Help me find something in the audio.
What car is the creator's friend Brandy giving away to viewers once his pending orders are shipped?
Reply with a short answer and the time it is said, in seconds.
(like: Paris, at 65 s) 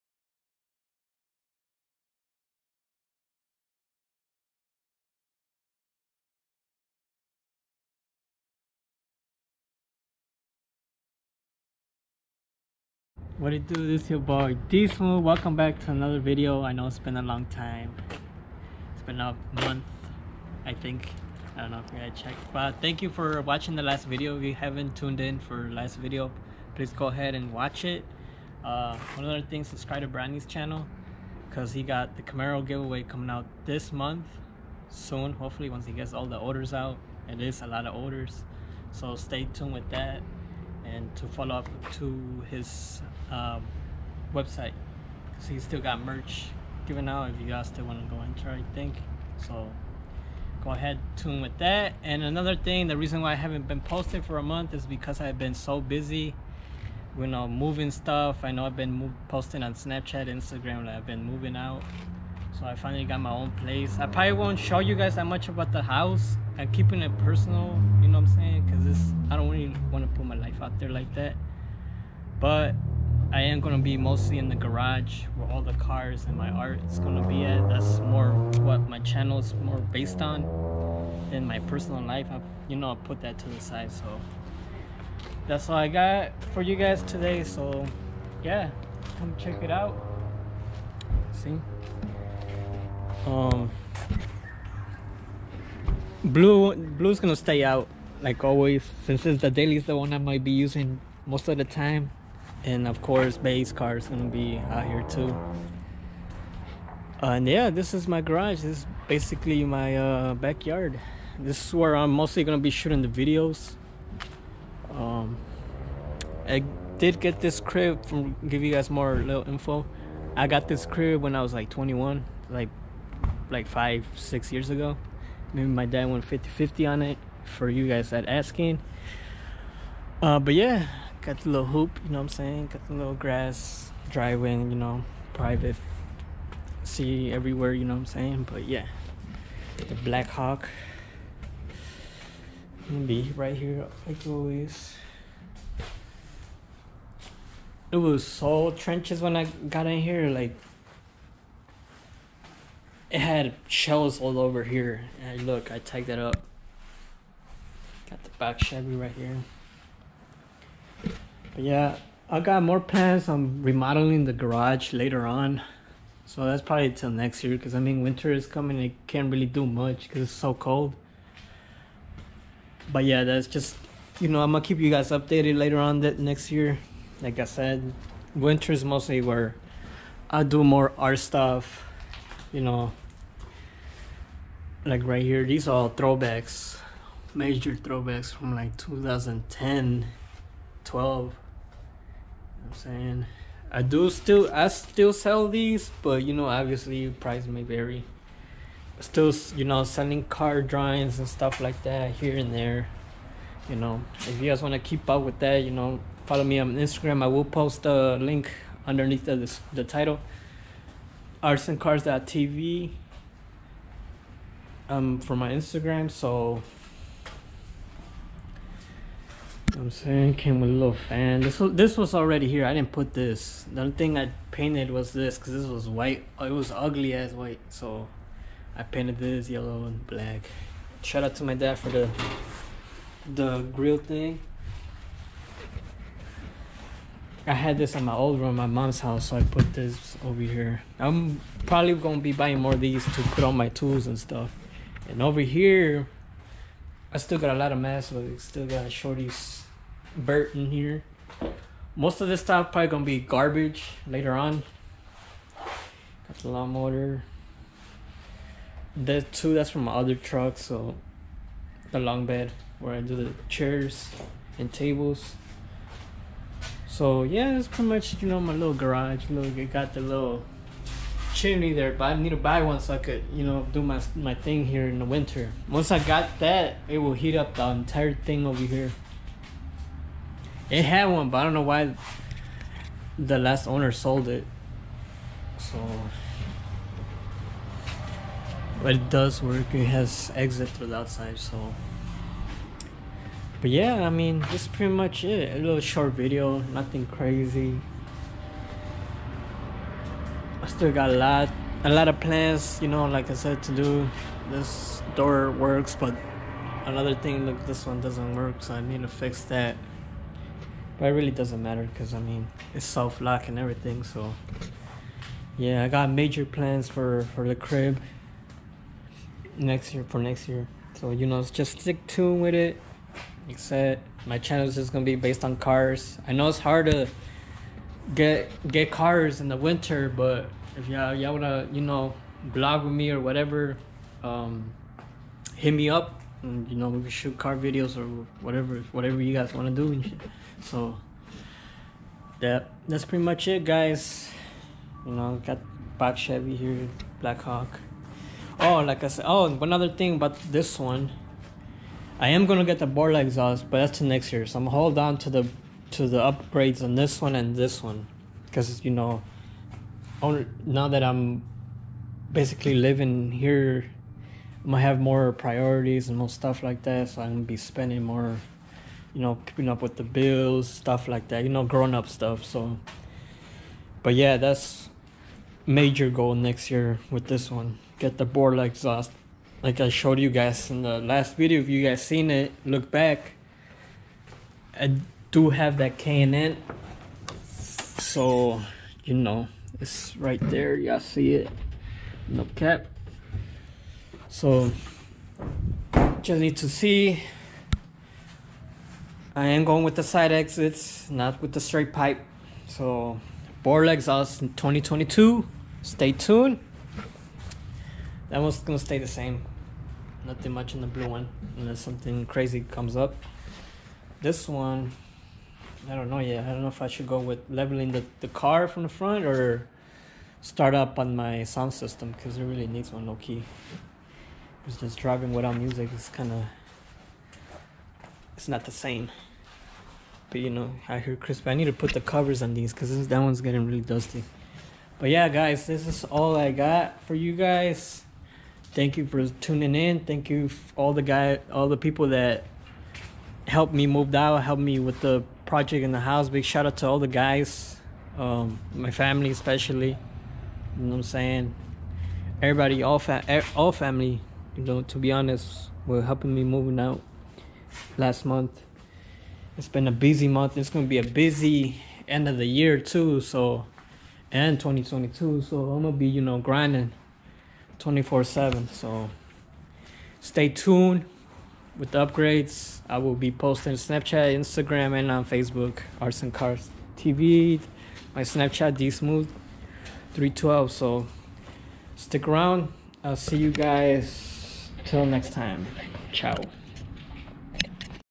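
Camaro, at 32 s.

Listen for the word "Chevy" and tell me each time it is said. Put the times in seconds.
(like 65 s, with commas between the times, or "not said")
158 s, 346 s.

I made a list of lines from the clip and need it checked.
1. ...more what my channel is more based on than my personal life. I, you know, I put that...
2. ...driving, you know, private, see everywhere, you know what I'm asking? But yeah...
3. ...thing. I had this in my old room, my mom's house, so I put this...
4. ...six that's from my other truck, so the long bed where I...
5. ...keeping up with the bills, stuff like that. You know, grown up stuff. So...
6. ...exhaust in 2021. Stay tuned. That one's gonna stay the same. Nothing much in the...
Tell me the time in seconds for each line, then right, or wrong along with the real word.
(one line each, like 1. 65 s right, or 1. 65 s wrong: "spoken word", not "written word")
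1. 77 s right
2. 134 s wrong: "saying", not "asking"
3. 233 s right
4. 259 s wrong: "two", not "six"
5. 369 s right
6. 403 s wrong: "2022", not "2021".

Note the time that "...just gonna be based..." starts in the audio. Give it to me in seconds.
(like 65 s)
324 s.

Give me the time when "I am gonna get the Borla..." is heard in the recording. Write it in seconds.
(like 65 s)
352 s.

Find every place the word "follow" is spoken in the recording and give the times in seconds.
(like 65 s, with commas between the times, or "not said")
41 s, 206 s.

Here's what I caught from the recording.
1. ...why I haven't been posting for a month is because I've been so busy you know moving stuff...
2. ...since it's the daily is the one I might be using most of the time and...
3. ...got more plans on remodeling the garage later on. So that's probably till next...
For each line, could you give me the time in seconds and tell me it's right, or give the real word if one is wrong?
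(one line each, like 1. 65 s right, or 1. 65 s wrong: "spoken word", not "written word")
1. 53 s right
2. 99 s right
3. 162 s right.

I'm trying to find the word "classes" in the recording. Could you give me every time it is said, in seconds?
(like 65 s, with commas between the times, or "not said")
not said.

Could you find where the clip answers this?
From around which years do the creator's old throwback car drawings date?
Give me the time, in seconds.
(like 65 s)
188 s.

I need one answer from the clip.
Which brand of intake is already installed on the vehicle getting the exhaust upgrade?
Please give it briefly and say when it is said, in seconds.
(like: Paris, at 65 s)
K and N, at 385 s.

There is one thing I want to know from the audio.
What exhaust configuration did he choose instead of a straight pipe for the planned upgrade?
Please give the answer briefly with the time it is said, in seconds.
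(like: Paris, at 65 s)
side exits, at 400 s.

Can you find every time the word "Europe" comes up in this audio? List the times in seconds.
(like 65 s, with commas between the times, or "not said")
not said.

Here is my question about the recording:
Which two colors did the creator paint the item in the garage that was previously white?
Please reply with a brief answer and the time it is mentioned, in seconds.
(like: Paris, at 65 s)
yellow and black, at 229 s.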